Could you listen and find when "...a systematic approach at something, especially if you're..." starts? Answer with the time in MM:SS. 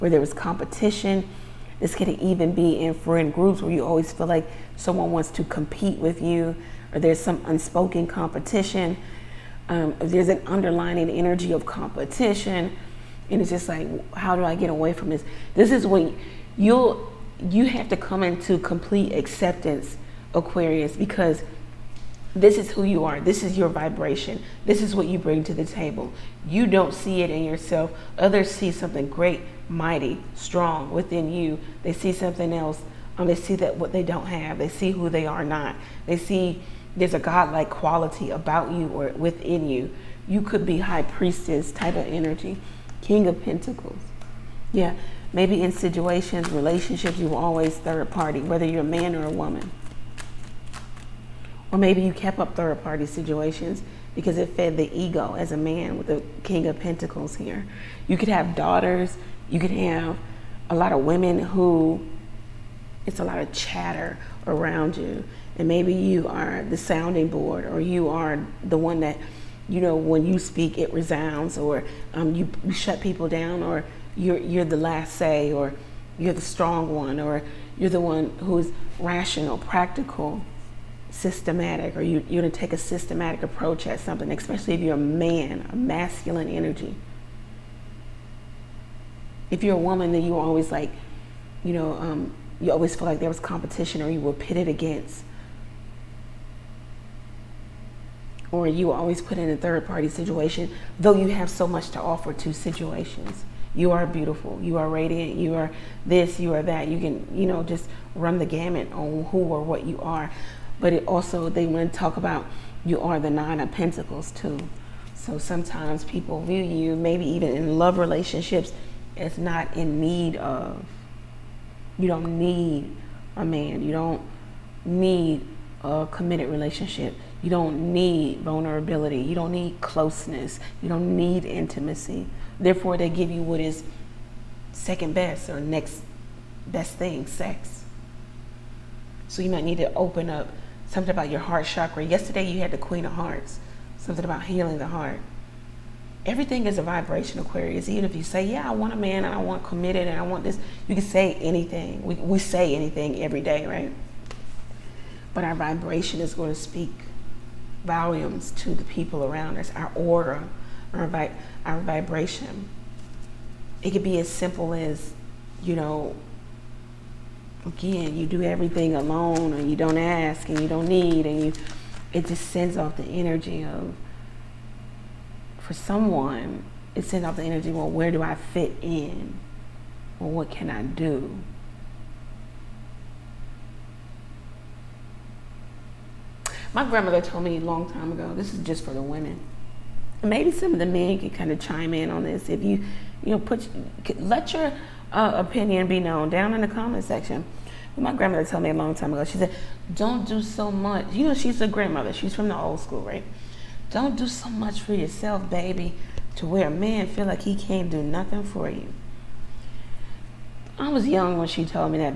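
01:22.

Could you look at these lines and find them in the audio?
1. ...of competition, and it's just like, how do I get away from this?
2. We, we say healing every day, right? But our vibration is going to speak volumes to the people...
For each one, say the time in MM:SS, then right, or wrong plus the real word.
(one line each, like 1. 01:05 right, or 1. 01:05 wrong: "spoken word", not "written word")
1. 00:11 right
2. 02:32 wrong: "anything", not "healing".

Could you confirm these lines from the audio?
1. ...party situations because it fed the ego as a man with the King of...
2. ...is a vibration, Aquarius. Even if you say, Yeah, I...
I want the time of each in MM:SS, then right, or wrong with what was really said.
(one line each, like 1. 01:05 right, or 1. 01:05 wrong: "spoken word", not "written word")
1. 00:52 right
2. 02:26 right.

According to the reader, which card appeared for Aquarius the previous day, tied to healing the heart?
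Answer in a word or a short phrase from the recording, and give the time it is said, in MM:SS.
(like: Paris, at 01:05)
Queen of Hearts, at 02:22.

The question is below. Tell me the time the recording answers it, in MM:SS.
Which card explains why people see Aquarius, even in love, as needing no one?
01:53.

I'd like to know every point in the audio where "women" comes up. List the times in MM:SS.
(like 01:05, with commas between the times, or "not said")
01:00, 03:09.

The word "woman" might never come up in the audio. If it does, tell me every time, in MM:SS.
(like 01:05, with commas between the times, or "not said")
00:49, 01:29.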